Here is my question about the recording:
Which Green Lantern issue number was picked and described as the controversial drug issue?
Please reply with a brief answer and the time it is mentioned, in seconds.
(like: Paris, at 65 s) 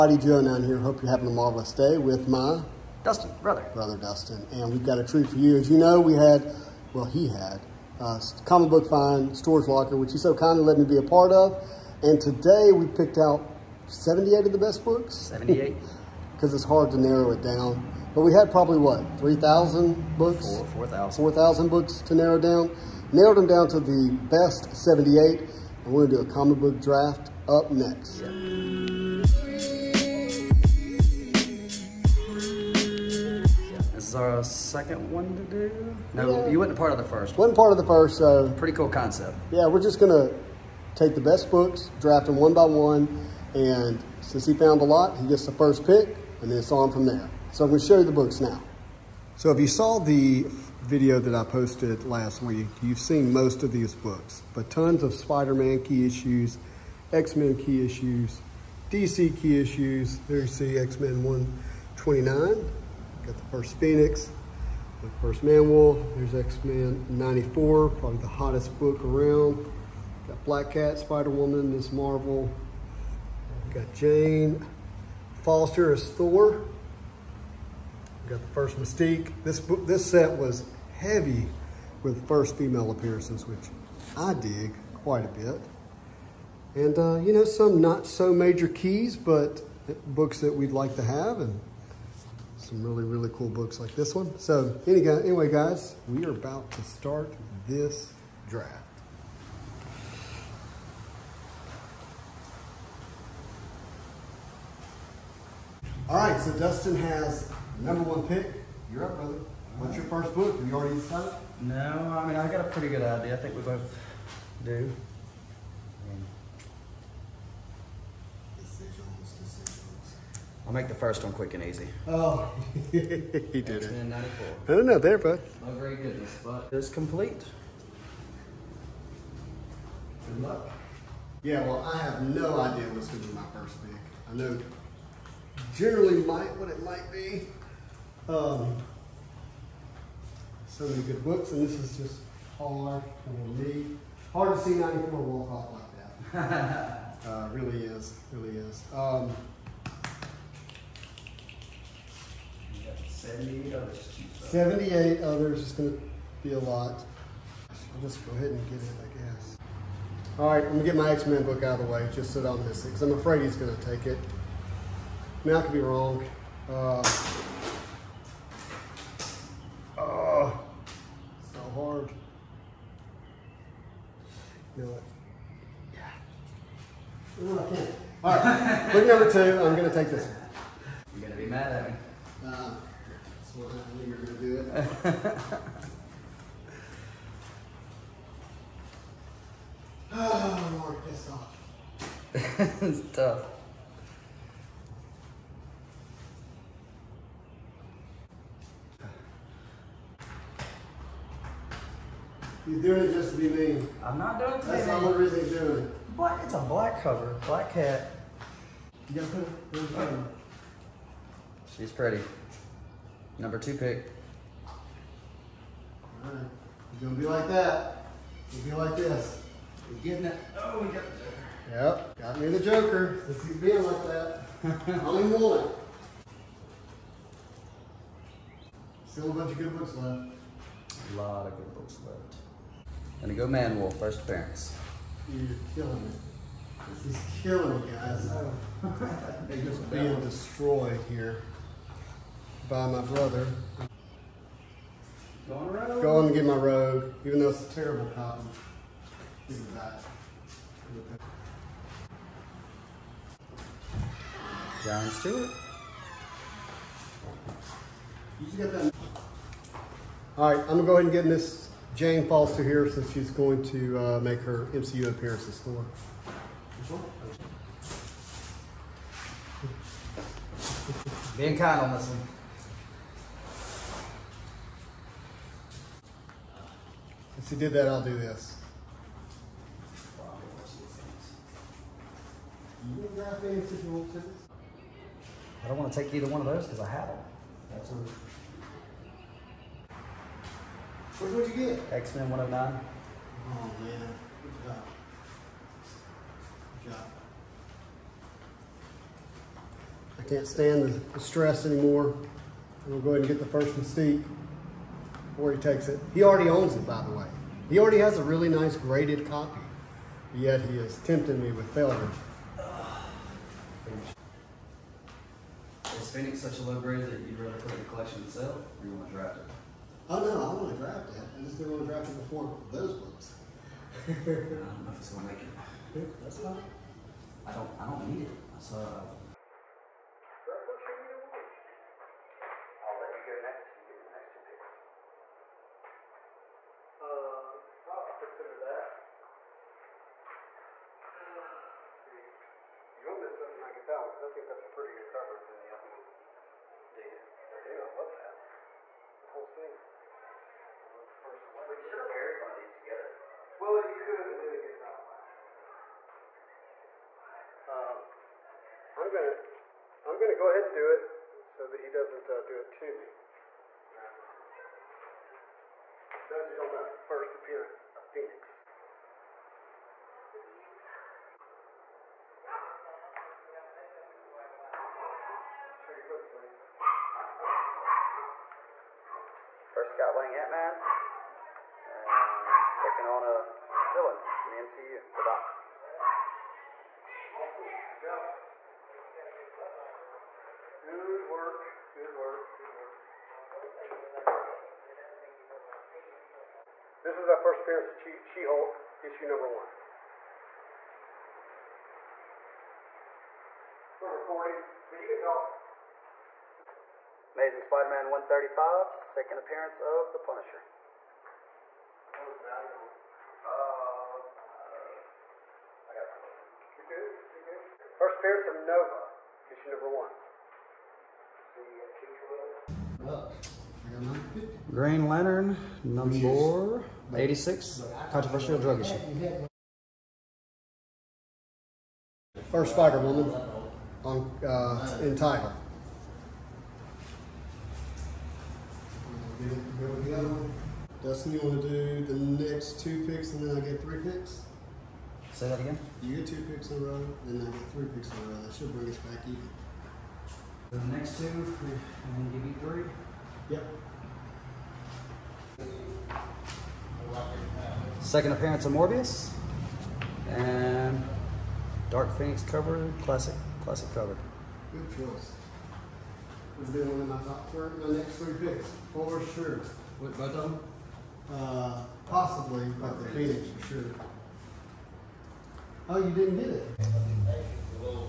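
86, at 424 s.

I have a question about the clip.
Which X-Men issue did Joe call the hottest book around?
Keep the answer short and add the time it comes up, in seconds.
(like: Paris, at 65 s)
94, at 66 s.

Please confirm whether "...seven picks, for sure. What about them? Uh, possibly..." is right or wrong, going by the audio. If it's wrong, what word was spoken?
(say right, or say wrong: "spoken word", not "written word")
wrong: "three", not "seven".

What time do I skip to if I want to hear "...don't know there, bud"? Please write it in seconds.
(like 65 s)
124 s.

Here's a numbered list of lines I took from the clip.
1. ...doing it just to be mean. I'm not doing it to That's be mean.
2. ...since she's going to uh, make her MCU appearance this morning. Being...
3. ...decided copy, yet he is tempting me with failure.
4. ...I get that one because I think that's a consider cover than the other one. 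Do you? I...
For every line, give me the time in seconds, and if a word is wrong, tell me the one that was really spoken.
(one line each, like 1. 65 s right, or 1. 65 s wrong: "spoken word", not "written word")
1. 202 s right
2. 262 s right
3. 308 s wrong: "graded", not "decided"
4. 343 s wrong: "prettier", not "consider".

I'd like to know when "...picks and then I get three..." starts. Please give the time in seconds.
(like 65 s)
443 s.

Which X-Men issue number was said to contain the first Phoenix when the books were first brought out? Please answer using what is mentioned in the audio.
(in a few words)
129.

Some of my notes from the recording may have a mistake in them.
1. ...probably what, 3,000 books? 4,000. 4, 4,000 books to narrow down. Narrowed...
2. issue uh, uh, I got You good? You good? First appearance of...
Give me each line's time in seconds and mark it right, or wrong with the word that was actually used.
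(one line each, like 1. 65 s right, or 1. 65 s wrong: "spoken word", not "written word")
1. 18 s right
2. 412 s wrong: "value", not "issue".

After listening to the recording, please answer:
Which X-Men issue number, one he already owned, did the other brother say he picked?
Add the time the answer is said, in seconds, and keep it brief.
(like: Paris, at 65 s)
109, at 291 s.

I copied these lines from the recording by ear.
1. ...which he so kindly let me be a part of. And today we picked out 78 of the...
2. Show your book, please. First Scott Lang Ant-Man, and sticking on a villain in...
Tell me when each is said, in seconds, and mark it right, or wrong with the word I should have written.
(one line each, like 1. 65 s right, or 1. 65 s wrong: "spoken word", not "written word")
1. 9 s right
2. 375 s right.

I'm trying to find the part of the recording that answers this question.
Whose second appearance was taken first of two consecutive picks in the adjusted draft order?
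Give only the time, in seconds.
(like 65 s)
458 s.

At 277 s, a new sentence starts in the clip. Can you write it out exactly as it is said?
Since he did that, I'll do this.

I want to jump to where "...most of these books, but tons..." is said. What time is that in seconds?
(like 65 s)
53 s.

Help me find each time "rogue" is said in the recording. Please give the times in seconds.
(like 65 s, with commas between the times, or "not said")
246 s.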